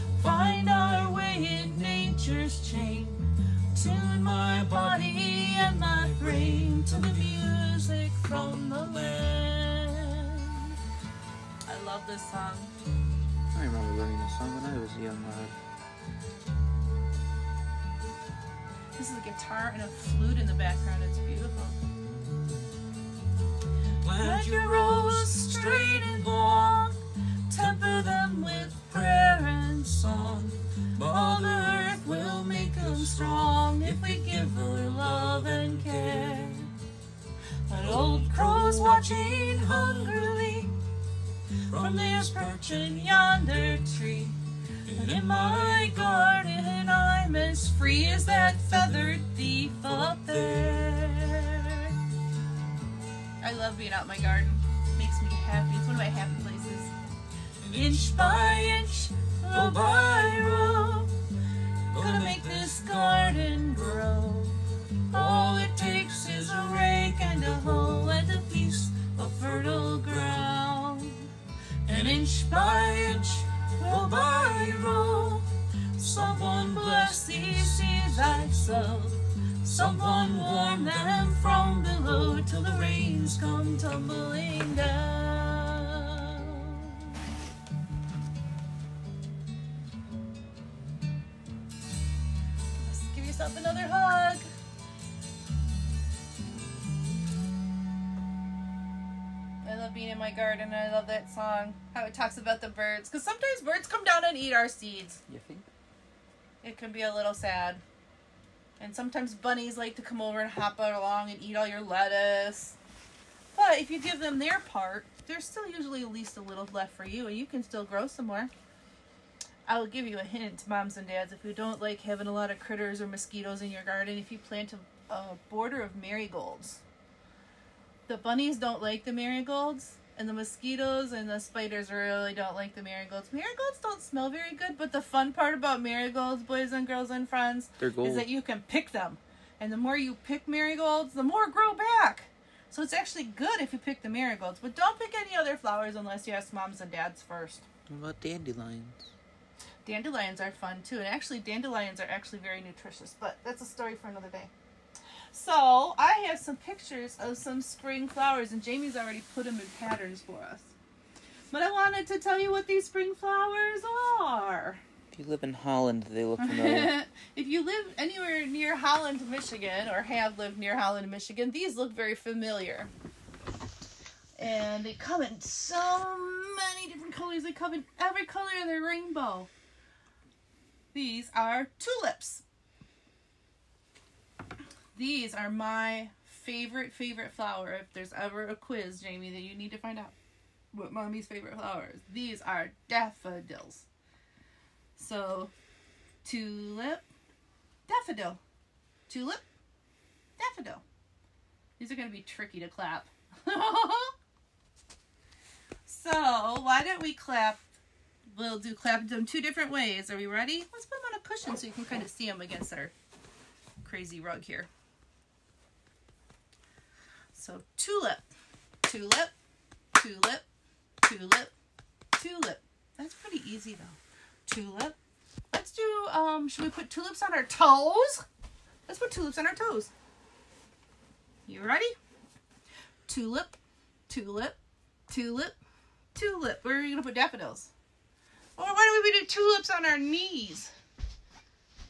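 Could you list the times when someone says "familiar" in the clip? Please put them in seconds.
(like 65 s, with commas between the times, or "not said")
166 s, 172 s.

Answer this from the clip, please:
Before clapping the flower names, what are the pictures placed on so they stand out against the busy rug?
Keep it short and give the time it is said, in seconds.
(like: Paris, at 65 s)
A cushion, at 211 s.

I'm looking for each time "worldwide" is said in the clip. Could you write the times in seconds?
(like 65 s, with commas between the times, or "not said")
not said.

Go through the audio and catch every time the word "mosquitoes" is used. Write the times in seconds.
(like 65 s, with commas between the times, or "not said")
123 s, 130 s.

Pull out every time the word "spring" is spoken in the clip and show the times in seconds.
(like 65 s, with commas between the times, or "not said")
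157 s, 162 s.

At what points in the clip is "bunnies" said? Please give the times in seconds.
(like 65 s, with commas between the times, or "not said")
109 s, 128 s.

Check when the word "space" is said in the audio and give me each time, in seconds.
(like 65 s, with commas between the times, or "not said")
not said.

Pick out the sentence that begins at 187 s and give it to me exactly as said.
If there's ever a quiz, Jamie, that you need to find out what mommy's favorite flower is, these are daffodils.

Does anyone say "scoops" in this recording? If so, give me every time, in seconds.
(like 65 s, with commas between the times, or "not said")
not said.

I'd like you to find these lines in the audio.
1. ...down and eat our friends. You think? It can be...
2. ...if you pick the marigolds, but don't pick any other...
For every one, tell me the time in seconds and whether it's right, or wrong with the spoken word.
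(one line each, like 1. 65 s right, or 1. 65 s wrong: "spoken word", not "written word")
1. 104 s wrong: "seeds", not "friends"
2. 143 s right.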